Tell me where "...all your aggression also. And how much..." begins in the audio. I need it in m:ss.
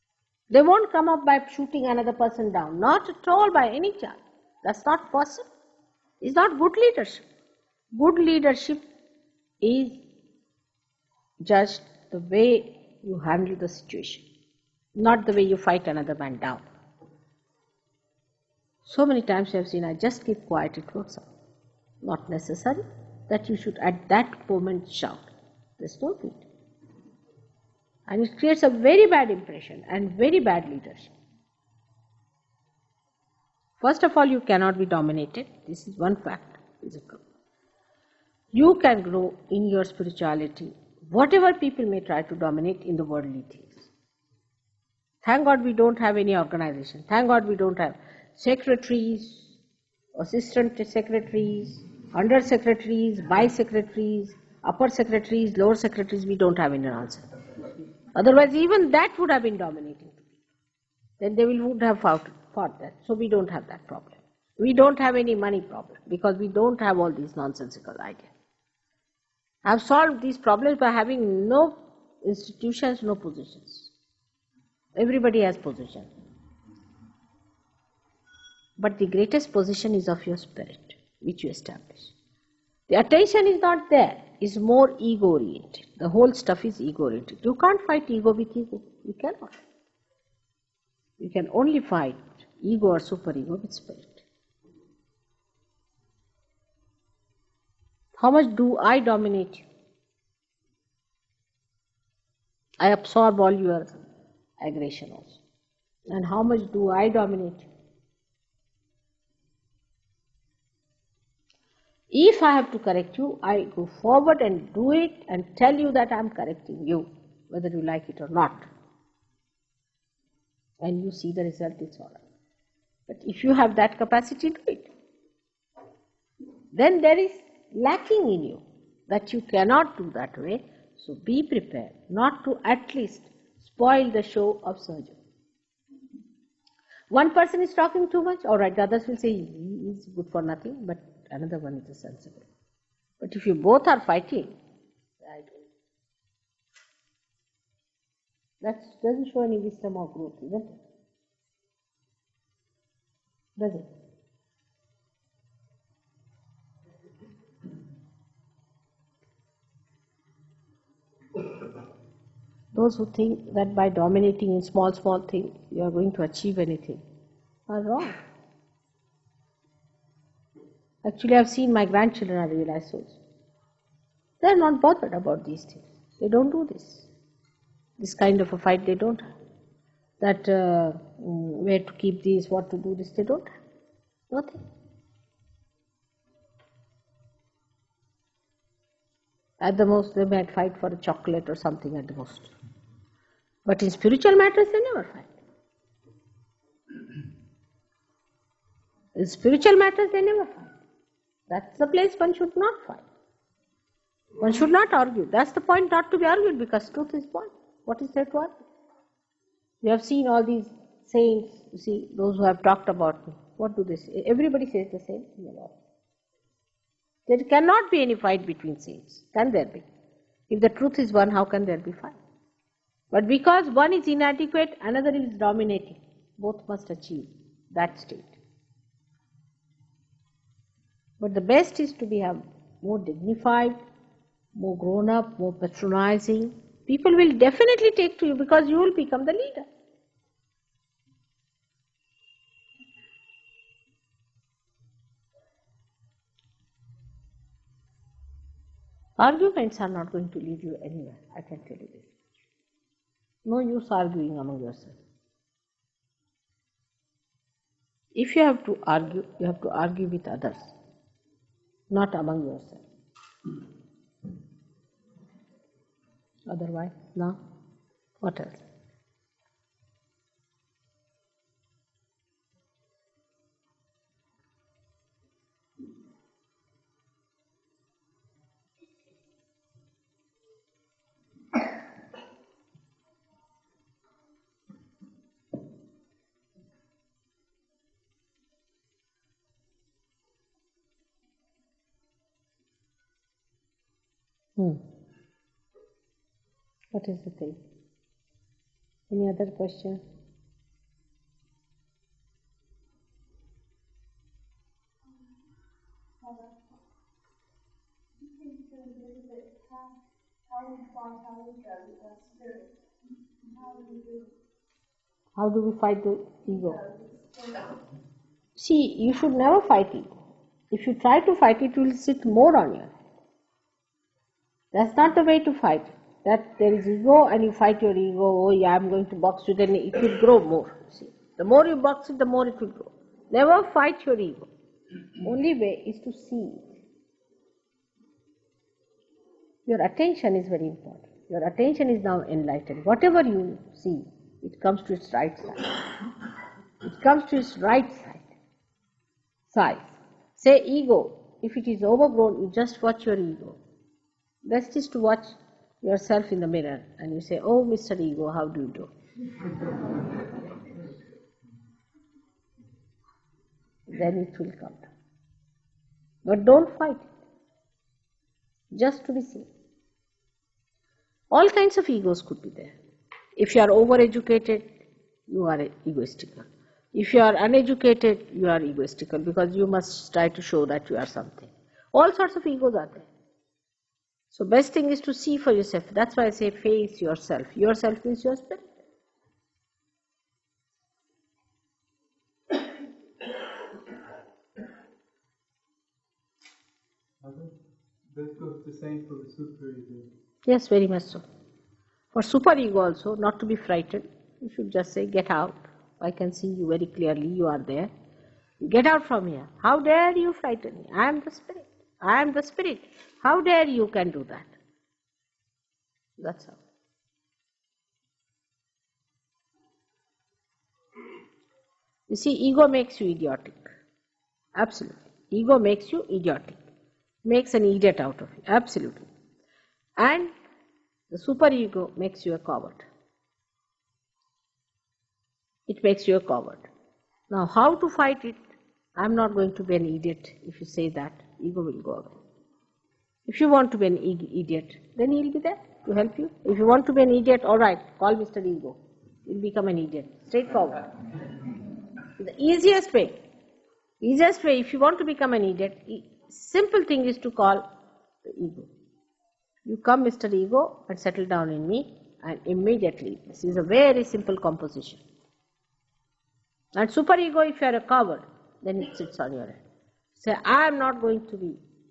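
1:43.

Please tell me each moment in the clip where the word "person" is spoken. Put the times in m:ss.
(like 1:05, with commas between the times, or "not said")
0:02, 2:17.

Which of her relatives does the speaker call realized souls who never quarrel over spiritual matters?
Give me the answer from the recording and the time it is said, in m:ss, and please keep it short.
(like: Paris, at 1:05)
grandchildren, at 2:51.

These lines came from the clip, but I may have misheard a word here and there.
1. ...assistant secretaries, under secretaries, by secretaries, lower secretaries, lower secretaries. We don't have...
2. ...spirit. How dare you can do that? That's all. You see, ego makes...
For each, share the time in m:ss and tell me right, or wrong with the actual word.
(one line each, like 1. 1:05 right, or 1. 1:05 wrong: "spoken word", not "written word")
1. 0:50 wrong: "upper", not "lower"
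2. 6:52 right.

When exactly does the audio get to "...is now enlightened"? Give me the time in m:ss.
5:41.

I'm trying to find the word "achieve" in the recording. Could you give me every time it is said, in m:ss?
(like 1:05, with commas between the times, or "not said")
2:46, 3:46.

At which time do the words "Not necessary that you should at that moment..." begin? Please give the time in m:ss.
0:22.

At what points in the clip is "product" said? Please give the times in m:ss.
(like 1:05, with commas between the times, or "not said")
not said.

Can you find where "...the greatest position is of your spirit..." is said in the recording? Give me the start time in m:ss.
1:18.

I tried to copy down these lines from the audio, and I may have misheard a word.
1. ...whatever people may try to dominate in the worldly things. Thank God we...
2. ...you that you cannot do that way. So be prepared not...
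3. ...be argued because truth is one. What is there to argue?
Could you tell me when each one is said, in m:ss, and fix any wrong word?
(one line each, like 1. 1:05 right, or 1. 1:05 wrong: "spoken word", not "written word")
1. 0:41 right
2. 2:08 right
3. 3:26 right.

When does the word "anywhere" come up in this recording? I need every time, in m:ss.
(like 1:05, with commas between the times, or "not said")
4:10.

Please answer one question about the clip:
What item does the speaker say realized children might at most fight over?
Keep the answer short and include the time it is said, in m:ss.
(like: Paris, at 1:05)
chocolate, at 3:10.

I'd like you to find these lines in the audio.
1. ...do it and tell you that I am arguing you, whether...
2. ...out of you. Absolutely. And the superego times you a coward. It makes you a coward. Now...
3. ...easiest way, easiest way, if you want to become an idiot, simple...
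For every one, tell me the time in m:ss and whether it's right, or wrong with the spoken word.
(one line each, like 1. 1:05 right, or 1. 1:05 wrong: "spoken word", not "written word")
1. 1:54 wrong: "correcting", not "arguing"
2. 7:07 wrong: "makes", not "times"
3. 7:32 right.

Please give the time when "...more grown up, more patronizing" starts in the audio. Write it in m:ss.
3:54.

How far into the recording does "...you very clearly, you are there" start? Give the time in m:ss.
6:46.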